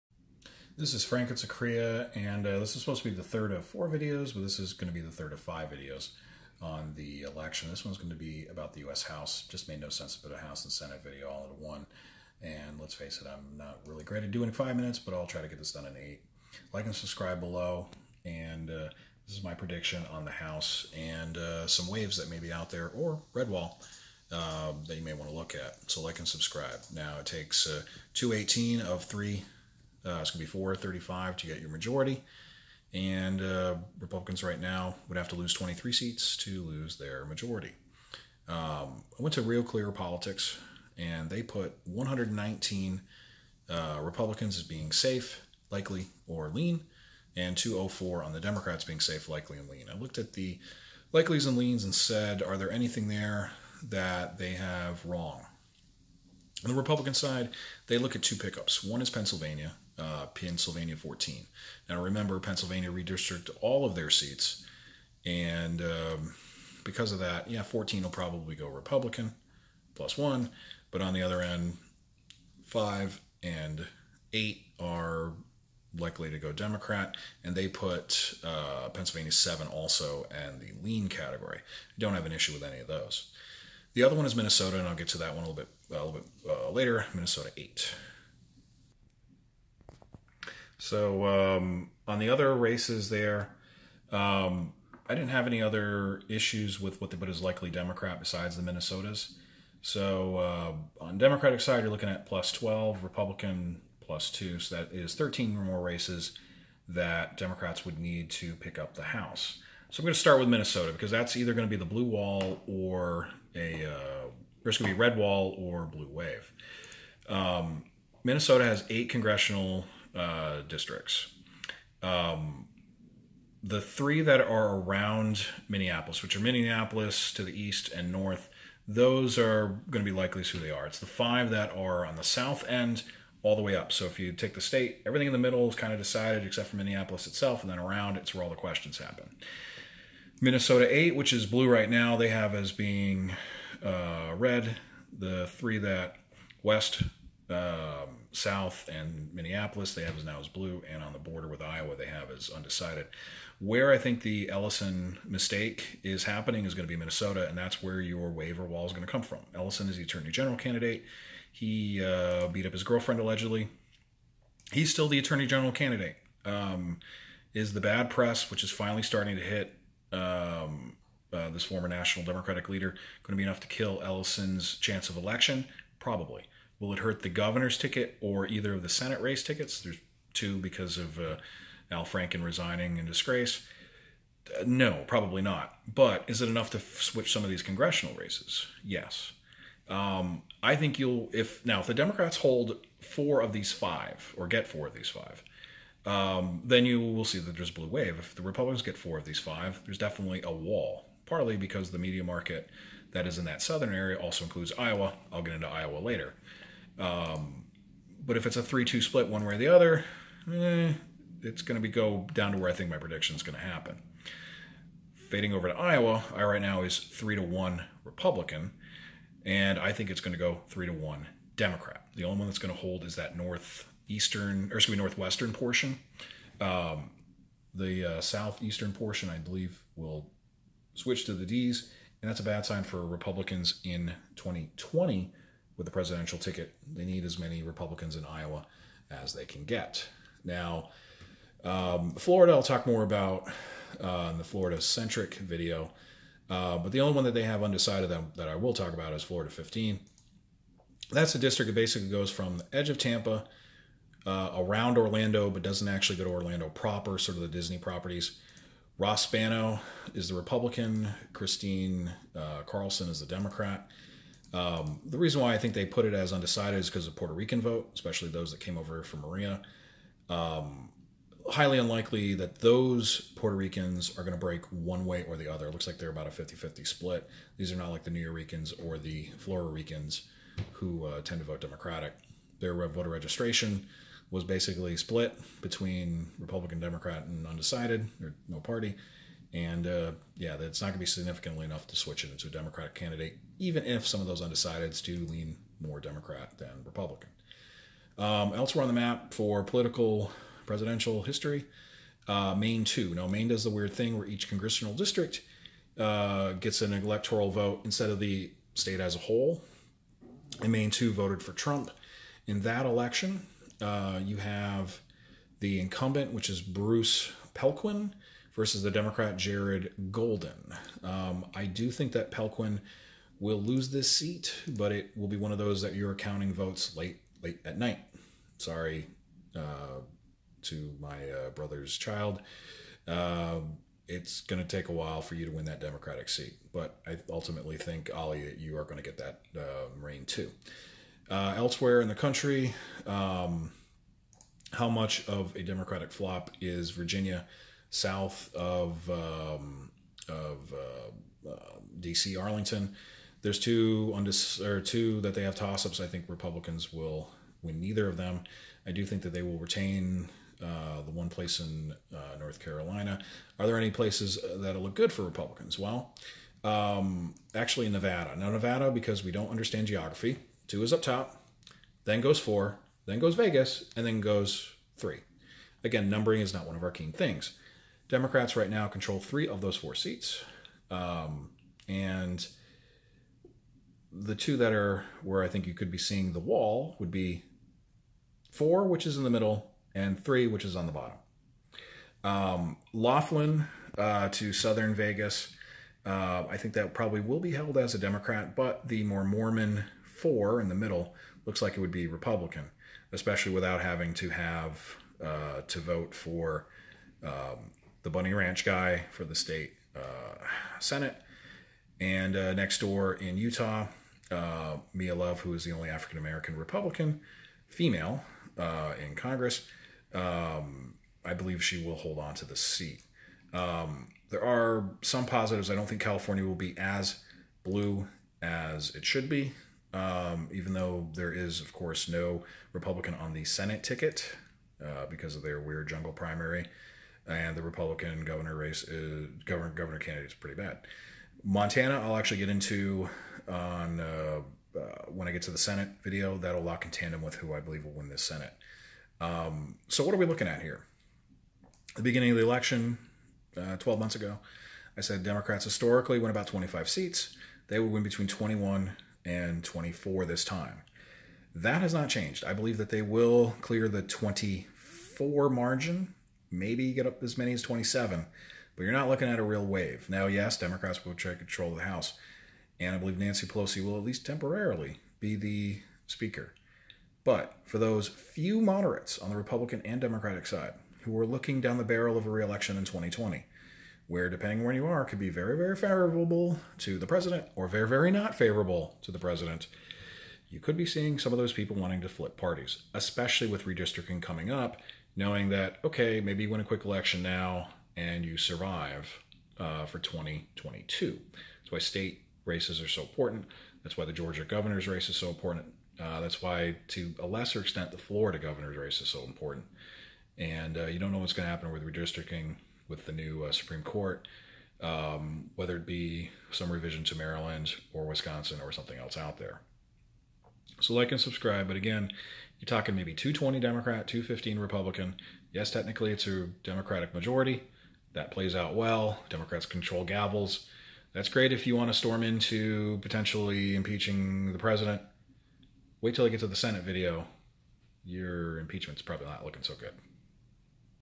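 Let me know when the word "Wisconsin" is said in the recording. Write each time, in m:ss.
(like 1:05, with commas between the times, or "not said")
8:38.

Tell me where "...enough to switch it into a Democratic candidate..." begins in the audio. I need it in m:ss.
4:51.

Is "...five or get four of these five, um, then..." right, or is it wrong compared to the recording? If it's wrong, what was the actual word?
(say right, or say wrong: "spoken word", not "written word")
right.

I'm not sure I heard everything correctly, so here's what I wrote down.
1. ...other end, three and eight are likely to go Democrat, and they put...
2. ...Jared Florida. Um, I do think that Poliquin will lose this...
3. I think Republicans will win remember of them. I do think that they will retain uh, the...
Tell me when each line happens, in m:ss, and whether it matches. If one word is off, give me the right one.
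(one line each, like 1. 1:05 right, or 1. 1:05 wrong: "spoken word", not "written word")
1. 1:11 wrong: "five", not "three"
2. 5:19 wrong: "Golden", not "Florida"
3. 5:55 wrong: "neither", not "remember".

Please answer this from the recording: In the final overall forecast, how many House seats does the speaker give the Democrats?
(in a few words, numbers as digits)
220.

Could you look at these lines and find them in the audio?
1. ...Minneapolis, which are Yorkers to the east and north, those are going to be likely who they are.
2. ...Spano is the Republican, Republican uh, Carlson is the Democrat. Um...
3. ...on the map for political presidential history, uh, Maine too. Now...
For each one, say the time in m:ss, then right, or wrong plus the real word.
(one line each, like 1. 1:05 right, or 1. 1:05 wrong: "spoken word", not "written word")
1. 2:05 wrong: "Minneapolis", not "Yorkers"
2. 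4:19 wrong: "Christine", not "Republican"
3. 4:58 right.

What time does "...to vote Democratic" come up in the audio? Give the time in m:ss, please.
4:41.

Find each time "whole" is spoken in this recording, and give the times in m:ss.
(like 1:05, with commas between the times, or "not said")
5:09.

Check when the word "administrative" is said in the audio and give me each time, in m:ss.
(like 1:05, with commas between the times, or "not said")
not said.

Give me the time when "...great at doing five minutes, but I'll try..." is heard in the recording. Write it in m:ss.
0:14.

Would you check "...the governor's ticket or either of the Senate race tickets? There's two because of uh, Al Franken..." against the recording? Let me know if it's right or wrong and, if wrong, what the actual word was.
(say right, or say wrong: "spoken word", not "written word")
right.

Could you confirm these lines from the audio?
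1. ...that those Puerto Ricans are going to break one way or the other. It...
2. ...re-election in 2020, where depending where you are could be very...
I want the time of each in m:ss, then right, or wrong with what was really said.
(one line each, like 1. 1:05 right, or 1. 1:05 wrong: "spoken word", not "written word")
1. 4:32 right
2. 8:02 right.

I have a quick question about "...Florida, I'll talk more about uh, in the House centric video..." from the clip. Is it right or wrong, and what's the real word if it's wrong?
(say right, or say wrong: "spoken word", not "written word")
wrong: "Florida", not "House".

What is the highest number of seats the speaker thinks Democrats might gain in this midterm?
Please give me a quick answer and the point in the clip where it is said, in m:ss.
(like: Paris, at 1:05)
27, at 7:47.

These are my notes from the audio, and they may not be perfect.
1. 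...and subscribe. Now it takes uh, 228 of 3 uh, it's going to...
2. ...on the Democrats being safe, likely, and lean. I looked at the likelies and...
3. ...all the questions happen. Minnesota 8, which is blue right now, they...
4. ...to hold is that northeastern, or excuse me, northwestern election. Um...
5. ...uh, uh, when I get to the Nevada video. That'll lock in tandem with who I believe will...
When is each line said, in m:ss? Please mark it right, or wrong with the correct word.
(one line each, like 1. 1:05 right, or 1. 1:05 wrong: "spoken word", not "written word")
1. 0:26 wrong: "218", not "228"
2. 0:48 right
3. 2:18 right
4. 3:42 wrong: "portion", not "election"
5. 7:23 wrong: "Senate", not "Nevada".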